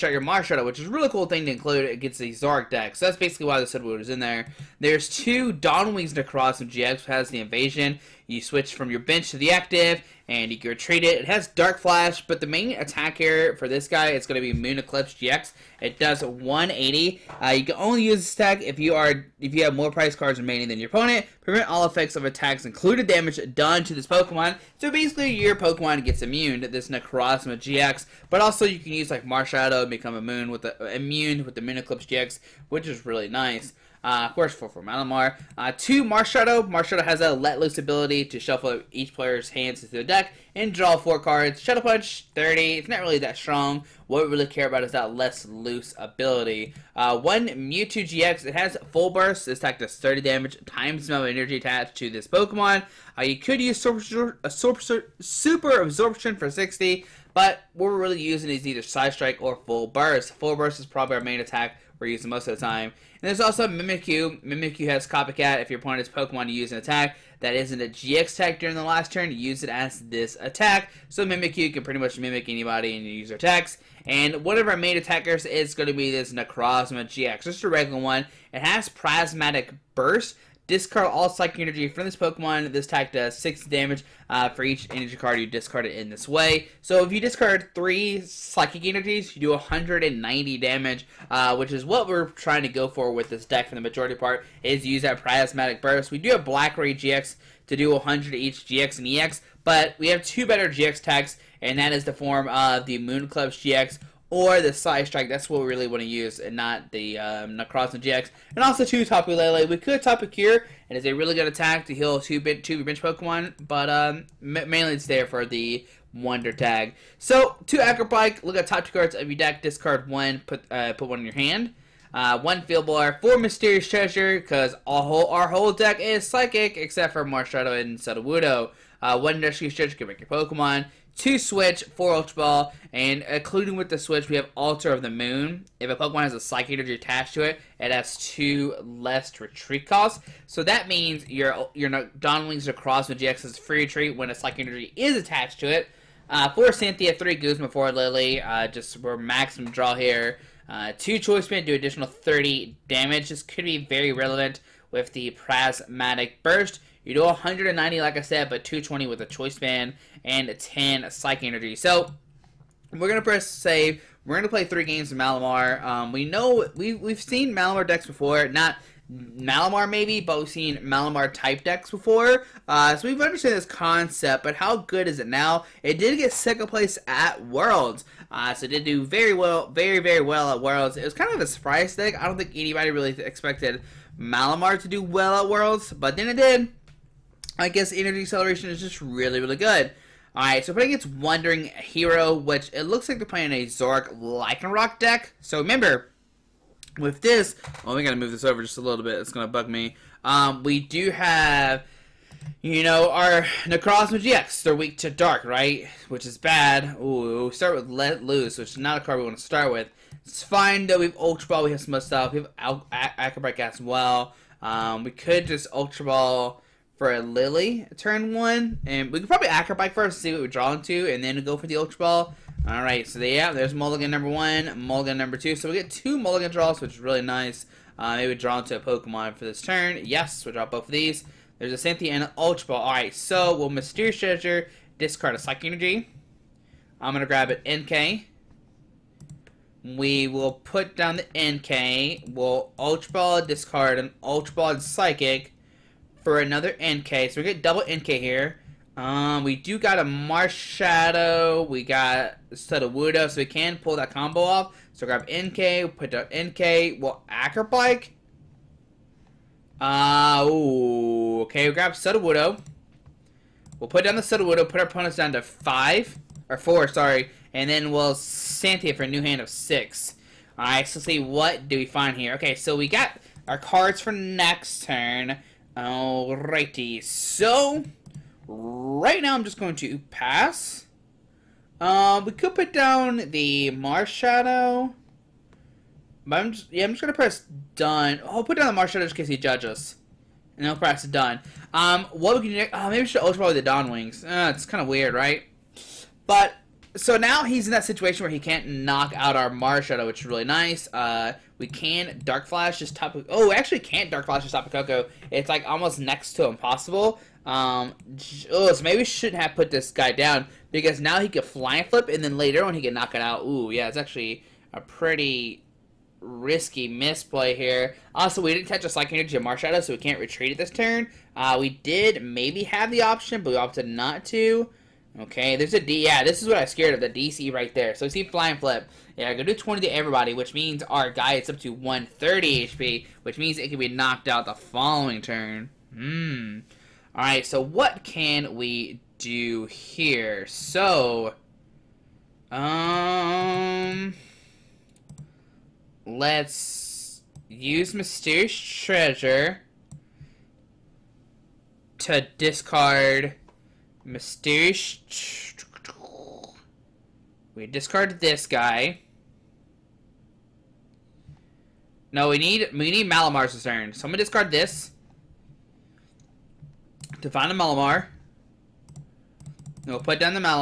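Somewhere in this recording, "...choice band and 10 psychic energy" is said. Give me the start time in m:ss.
2:39.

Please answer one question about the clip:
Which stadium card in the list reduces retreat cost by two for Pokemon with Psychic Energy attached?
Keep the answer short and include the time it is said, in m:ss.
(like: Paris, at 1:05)
Altar of the Moon, at 2:14.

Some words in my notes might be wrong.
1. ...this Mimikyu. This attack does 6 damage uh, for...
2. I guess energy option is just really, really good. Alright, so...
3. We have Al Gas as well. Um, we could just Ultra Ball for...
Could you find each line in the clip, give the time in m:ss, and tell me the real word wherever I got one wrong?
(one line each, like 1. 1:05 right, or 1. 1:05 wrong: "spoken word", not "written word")
1. 1:22 wrong: "Pokemon", not "Mimikyu"
2. 3:07 wrong: "acceleration", not "option"
3. 3:32 right.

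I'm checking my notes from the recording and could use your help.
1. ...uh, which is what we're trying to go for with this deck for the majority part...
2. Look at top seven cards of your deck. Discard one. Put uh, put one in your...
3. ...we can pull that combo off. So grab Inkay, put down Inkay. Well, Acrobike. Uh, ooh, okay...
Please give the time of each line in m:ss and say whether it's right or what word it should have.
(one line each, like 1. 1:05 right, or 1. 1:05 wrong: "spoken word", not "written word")
1. 1:31 right
2. 1:58 wrong: "two", not "seven"
3. 4:13 right.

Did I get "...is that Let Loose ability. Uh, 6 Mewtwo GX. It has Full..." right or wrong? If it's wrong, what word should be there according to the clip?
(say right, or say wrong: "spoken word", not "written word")
wrong: "1", not "6".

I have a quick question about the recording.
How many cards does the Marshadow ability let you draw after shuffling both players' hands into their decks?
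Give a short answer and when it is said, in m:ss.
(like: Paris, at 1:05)
4, at 0:40.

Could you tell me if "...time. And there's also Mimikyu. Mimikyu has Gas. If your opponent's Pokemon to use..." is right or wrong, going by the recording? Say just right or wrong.
wrong.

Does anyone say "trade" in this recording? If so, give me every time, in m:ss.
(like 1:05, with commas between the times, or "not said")
0:10.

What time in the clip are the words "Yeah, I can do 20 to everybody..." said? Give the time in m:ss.
5:29.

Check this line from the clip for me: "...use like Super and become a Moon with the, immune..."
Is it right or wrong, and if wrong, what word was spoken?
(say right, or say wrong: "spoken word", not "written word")
wrong: "Marshadow", not "Super".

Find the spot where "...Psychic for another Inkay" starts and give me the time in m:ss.
4:04.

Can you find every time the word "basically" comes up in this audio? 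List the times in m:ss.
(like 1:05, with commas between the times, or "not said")
0:03, 0:24.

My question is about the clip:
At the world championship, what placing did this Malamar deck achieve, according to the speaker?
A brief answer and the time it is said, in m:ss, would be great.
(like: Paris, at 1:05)
Second place, at 2:56.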